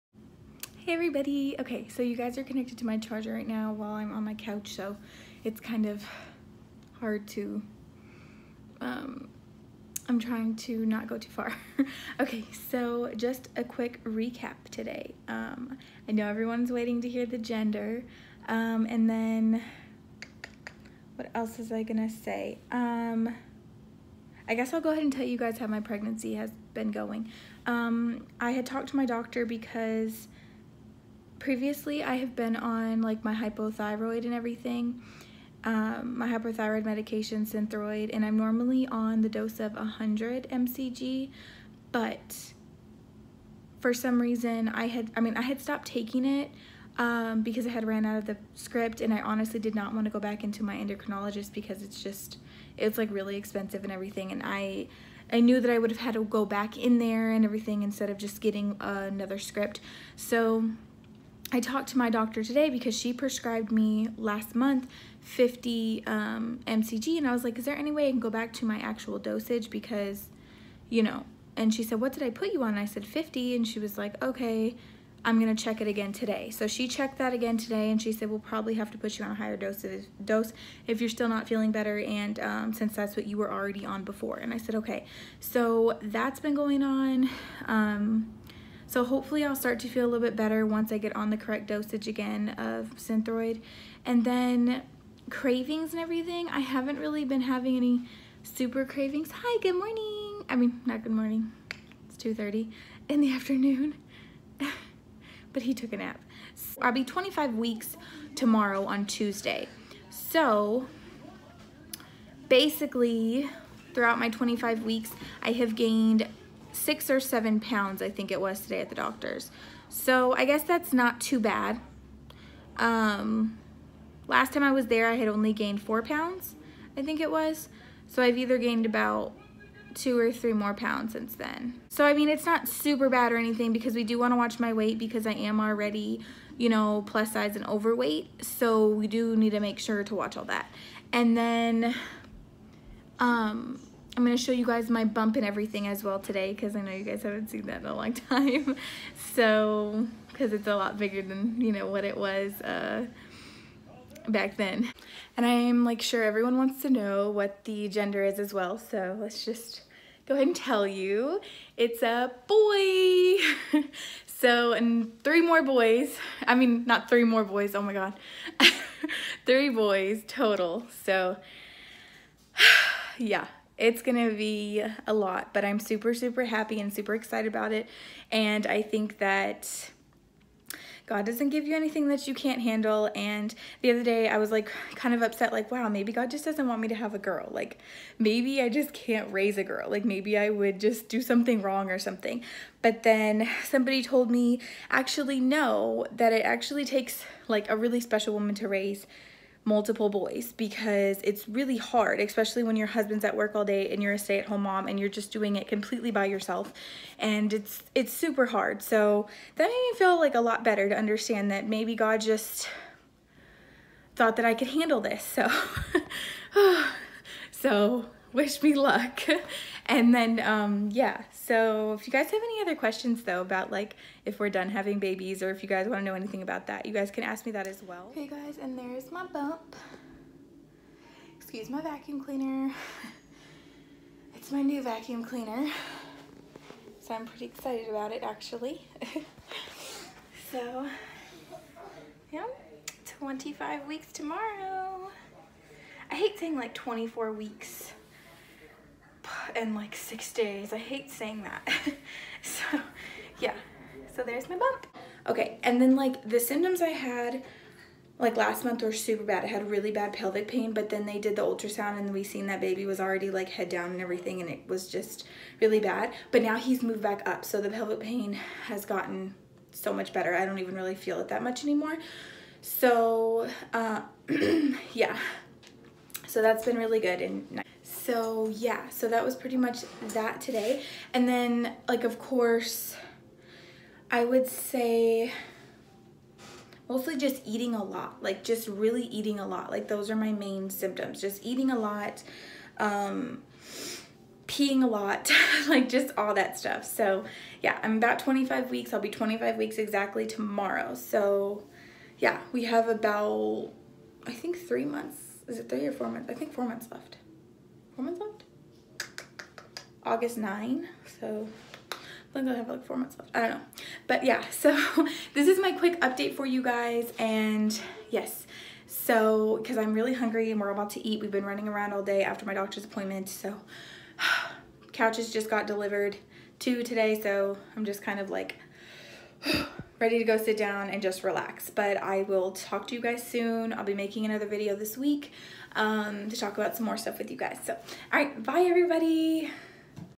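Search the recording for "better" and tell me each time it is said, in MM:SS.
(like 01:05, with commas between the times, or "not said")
01:21, 01:30, 03:30, 04:30.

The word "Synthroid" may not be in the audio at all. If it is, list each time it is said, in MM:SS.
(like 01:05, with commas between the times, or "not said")
00:37, 01:32.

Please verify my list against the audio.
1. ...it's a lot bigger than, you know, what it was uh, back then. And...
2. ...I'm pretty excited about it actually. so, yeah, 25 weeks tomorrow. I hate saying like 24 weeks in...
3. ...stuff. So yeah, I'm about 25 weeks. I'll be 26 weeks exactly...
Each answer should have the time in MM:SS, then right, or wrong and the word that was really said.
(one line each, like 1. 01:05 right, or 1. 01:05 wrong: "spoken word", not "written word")
1. 02:30 right
2. 03:57 right
3. 04:56 wrong: "25", not "26".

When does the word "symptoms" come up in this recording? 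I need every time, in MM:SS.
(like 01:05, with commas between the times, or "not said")
04:16, 04:50.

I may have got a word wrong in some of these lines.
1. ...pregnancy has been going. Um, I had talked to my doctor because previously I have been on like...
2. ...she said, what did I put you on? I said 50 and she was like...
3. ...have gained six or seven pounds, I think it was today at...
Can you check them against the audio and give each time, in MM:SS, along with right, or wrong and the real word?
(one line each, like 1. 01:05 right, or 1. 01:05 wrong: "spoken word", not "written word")
1. 00:25 right
2. 01:11 right
3. 01:55 right.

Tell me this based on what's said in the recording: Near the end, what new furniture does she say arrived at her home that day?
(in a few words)
couches.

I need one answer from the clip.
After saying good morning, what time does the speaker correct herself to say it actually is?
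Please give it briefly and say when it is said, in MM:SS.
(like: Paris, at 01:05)
2:30, at 01:42.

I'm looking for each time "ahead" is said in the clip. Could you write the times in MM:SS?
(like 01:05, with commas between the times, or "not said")
00:24, 02:40.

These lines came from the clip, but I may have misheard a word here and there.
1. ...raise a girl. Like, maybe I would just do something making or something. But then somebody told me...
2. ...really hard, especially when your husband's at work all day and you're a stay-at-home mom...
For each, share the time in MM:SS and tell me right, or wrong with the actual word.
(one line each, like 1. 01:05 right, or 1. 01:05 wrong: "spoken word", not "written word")
1. 03:09 wrong: "wrong", not "making"
2. 03:21 right.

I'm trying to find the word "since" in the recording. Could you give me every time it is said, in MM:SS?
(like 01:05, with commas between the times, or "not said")
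01:22, 02:11.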